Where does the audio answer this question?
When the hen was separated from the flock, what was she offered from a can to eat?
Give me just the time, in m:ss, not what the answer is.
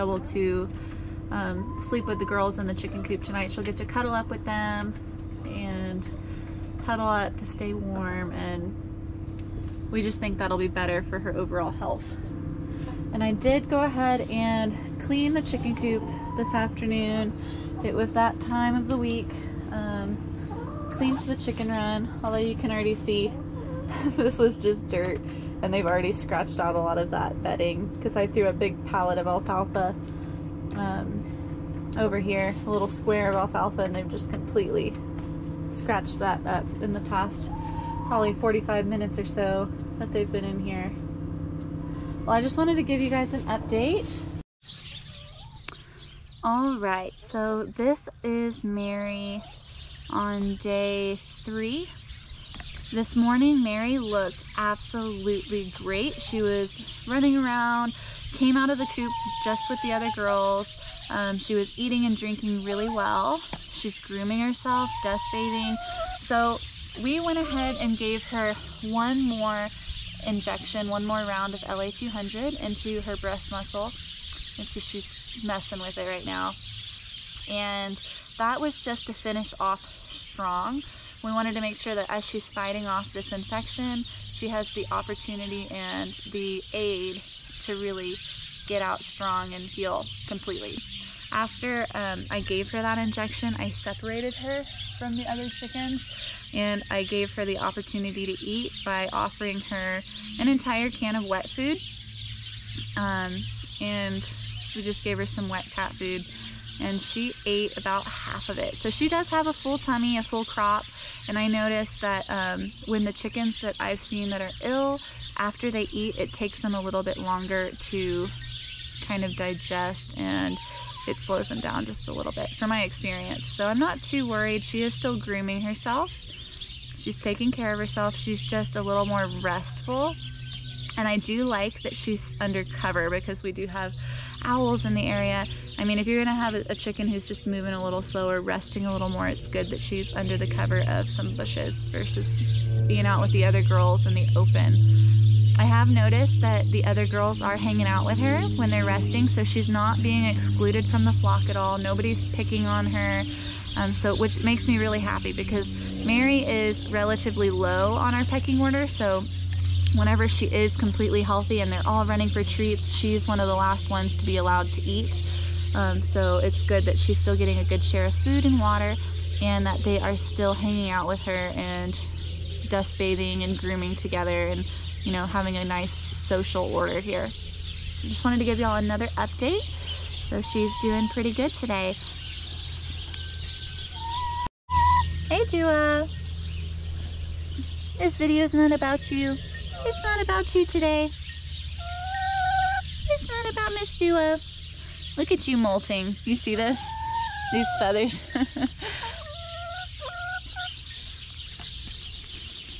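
1:45.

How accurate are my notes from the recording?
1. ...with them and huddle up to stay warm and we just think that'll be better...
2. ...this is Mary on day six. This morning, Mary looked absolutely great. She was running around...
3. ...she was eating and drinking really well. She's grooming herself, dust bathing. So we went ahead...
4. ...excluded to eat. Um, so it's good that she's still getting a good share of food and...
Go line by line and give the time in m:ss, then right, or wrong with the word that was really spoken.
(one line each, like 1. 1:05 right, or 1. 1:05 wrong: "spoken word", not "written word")
1. 0:04 right
2. 0:47 wrong: "three", not "six"
3. 1:01 right
4. 2:44 wrong: "allowed", not "excluded".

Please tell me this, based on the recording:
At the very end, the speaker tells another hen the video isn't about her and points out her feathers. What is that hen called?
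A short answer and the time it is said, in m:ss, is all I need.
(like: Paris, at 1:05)
Miss Dua, at 3:13.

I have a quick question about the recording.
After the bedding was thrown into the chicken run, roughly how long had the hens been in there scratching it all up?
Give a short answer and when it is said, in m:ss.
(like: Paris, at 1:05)
45 minutes, at 0:38.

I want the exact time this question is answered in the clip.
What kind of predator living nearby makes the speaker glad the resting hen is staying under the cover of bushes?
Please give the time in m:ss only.
2:14.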